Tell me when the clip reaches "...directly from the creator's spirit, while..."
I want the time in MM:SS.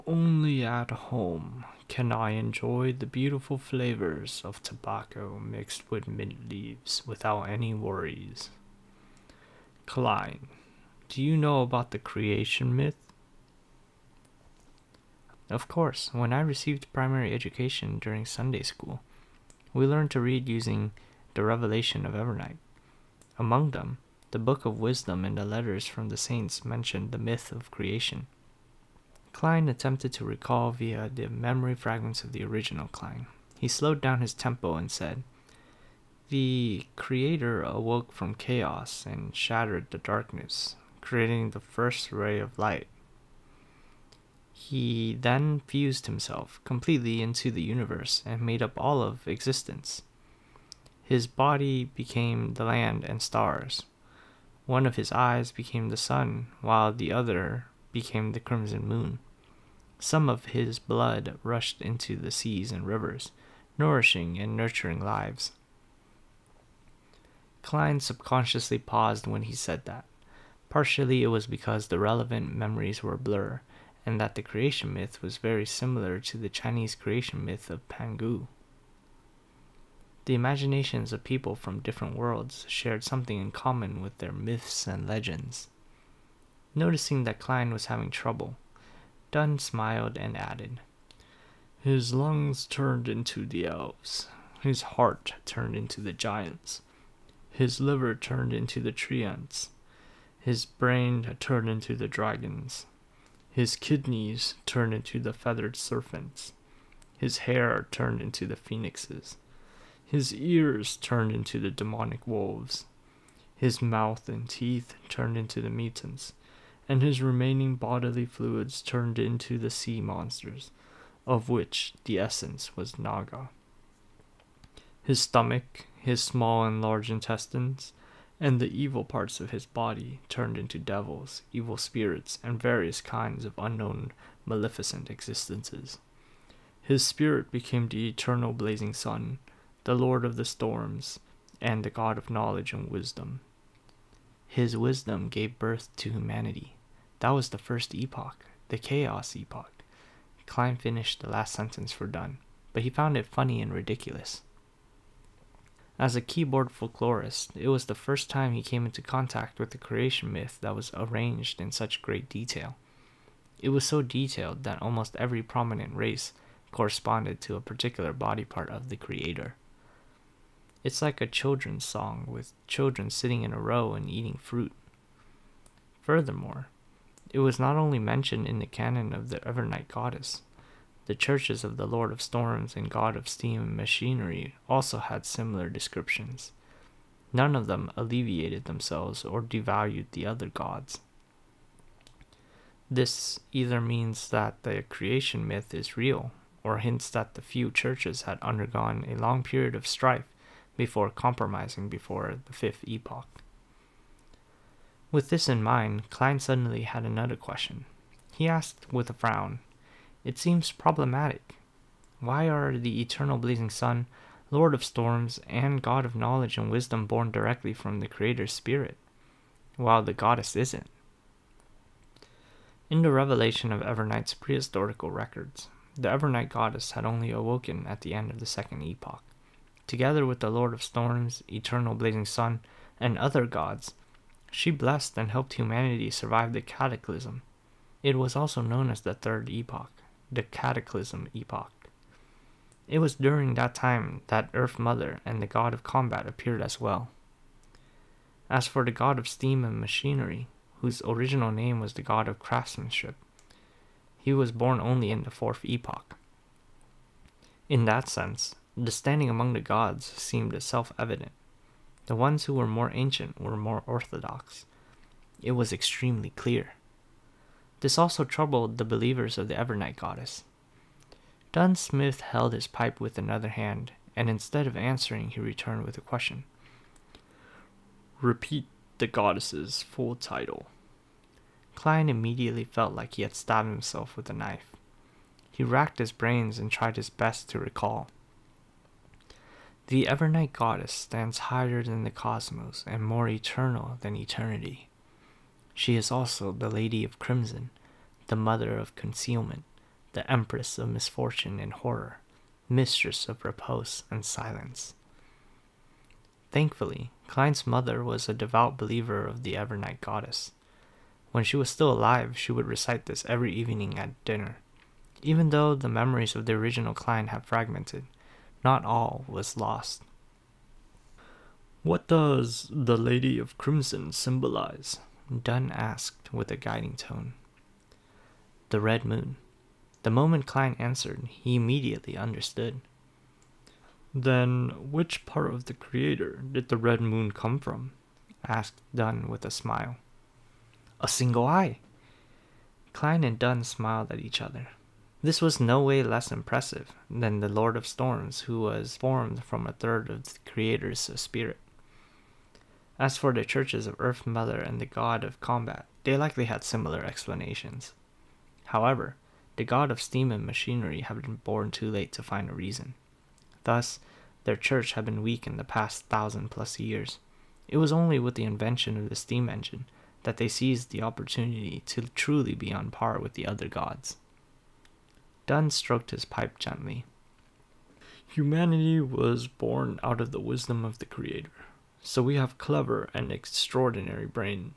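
03:37.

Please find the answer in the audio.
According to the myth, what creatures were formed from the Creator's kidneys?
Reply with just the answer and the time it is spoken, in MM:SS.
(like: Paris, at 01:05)
Feathered serpents, at 01:45.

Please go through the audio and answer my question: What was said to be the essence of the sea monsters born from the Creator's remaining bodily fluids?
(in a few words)
Naga.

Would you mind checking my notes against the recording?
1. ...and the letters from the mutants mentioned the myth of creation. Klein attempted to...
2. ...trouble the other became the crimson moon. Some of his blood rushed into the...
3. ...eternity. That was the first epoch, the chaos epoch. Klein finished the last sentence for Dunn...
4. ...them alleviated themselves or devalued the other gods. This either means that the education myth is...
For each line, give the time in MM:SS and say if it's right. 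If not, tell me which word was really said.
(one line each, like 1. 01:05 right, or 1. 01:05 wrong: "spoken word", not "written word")
1. 00:25 wrong: "saints", not "mutants"
2. 00:56 wrong: "while", not "trouble"
3. 02:26 wrong: "humanity", not "eternity"
4. 03:07 wrong: "creation", not "education".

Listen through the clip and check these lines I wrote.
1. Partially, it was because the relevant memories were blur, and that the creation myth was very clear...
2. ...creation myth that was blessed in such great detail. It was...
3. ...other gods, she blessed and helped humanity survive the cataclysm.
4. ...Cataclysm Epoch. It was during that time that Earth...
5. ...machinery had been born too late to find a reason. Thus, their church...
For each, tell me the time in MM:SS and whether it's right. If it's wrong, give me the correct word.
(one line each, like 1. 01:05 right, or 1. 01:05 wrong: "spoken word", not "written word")
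1. 01:10 wrong: "similar", not "clear"
2. 02:39 wrong: "arranged", not "blessed"
3. 03:53 right
4. 04:00 right
5. 06:00 right.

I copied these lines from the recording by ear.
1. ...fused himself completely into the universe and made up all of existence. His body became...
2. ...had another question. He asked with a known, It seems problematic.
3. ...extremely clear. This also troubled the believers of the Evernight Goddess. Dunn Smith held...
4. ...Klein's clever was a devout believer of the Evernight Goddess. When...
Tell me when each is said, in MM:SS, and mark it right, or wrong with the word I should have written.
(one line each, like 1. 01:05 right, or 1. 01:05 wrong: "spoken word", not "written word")
1. 00:45 right
2. 03:26 wrong: "frown", not "known"
3. 04:25 right
4. 05:07 wrong: "mother", not "clever".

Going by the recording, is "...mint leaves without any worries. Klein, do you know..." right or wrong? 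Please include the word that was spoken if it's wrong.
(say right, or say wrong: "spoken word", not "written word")
right.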